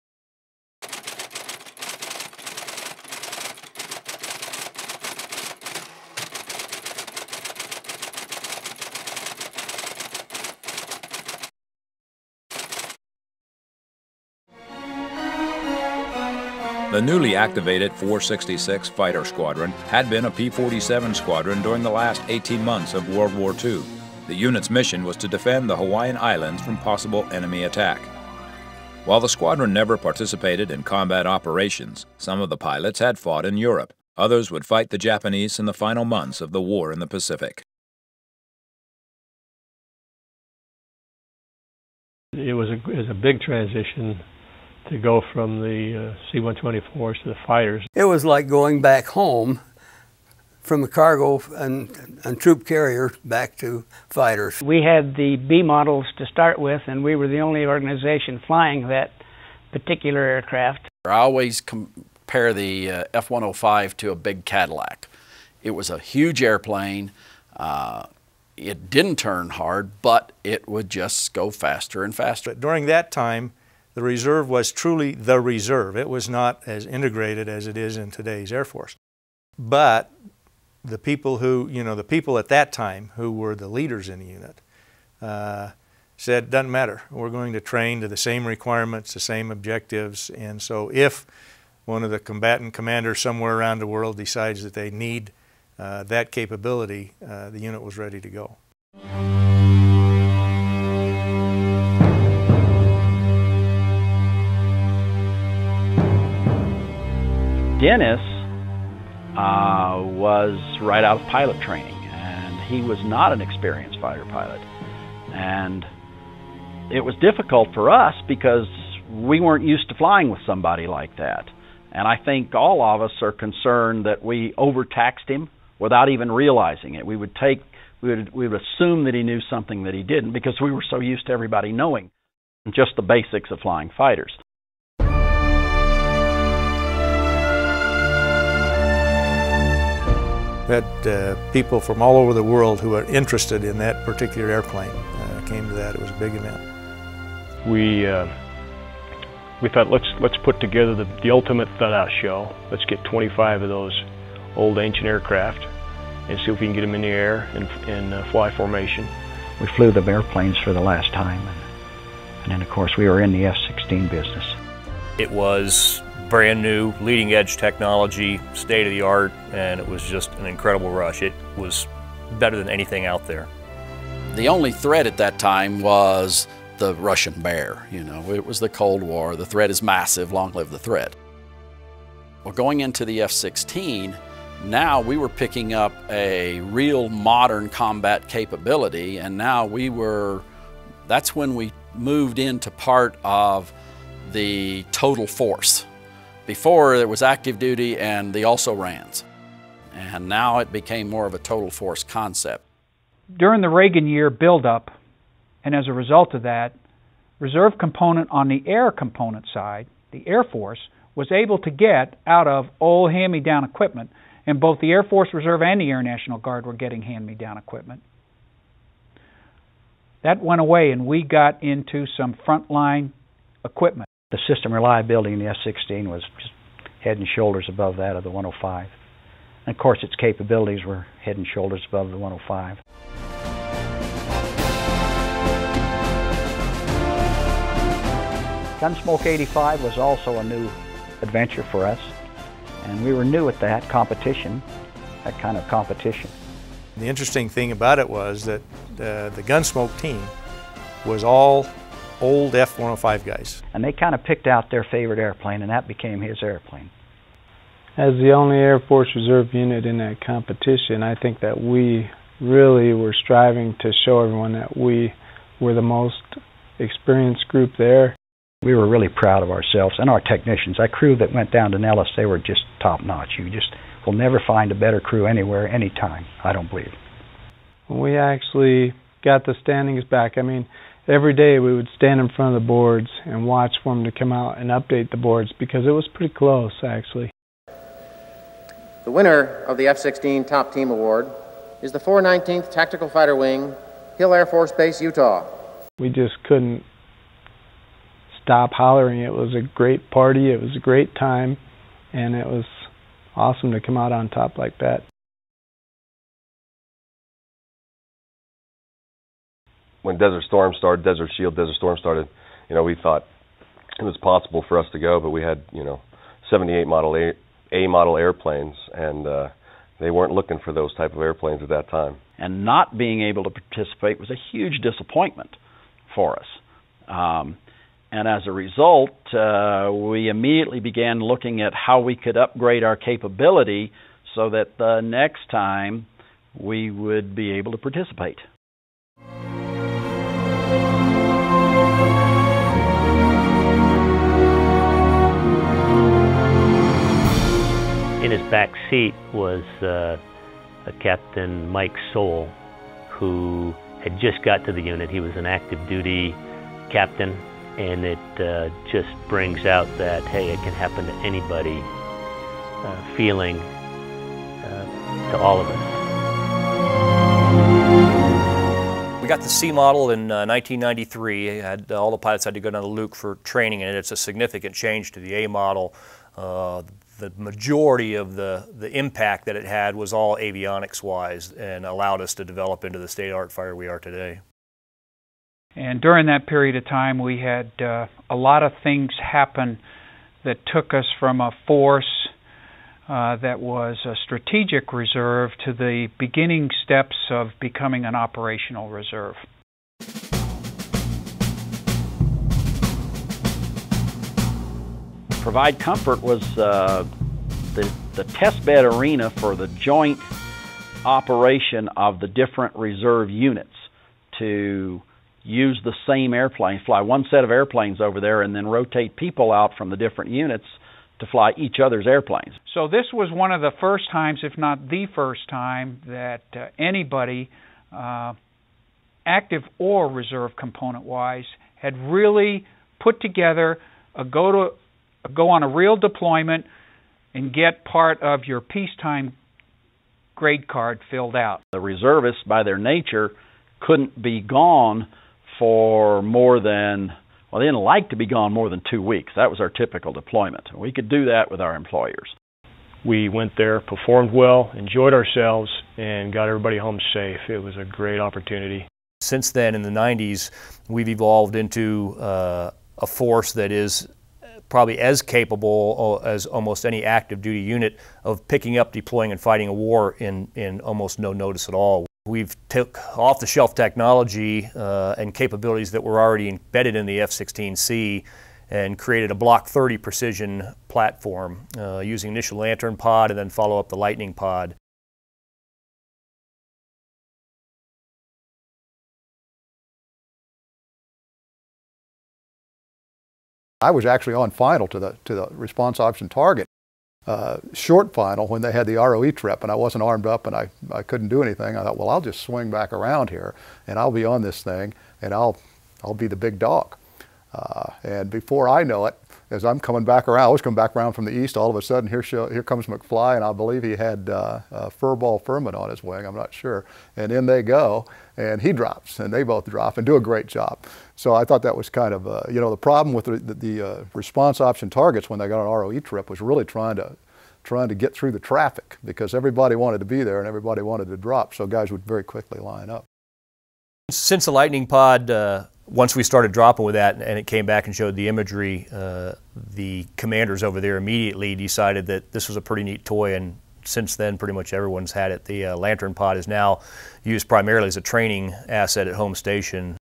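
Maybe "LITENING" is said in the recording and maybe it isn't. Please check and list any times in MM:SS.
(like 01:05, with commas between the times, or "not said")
08:03, 08:54.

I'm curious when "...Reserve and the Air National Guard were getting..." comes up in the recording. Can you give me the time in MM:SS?
03:35.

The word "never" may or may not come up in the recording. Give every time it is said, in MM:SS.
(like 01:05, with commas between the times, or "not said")
00:29, 04:34.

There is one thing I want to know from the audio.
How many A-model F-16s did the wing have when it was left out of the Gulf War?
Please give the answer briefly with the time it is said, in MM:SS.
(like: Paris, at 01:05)
78, at 05:16.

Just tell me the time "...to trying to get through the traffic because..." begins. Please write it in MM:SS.
08:46.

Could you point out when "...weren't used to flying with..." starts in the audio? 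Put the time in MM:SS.
01:59.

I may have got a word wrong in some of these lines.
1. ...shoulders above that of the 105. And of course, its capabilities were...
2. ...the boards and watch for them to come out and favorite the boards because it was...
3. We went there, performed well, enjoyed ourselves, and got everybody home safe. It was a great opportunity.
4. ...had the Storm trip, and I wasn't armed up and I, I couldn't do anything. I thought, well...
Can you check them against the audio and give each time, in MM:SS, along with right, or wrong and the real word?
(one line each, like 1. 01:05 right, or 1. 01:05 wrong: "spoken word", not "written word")
1. 03:47 right
2. 04:42 wrong: "update", not "favorite"
3. 07:33 right
4. 08:18 wrong: "ROE", not "Storm".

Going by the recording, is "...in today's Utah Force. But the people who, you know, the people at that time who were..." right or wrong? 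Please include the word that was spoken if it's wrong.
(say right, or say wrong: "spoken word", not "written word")
wrong: "Air", not "Utah".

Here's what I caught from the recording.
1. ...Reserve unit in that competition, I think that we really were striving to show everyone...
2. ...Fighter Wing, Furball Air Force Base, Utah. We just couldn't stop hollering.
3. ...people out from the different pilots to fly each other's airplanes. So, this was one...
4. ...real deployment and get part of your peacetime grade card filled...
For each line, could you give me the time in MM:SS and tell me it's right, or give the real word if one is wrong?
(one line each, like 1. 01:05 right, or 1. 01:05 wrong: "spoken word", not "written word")
1. 04:19 right
2. 04:53 wrong: "Hill", not "Furball"
3. 06:59 wrong: "units", not "pilots"
4. 07:15 right.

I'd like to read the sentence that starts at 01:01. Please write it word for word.
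I always compare the uh, F-105 to a big Cadillac.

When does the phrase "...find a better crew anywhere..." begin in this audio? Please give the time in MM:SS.
04:34.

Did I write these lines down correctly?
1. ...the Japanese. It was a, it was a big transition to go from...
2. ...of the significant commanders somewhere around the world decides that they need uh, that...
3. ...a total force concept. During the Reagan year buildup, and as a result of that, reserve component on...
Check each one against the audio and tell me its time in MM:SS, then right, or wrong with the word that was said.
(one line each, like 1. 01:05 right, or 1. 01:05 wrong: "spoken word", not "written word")
1. 00:36 wrong: "Pacific", not "Japanese"
2. 01:32 wrong: "combatant", not "significant"
3. 03:21 right.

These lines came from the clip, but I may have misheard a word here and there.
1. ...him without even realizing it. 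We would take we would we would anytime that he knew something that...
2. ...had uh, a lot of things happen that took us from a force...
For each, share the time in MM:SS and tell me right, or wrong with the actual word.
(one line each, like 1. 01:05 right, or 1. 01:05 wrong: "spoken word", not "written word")
1. 02:05 wrong: "assume", not "anytime"
2. 06:27 right.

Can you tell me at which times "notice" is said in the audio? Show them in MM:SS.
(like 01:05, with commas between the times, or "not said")
07:51.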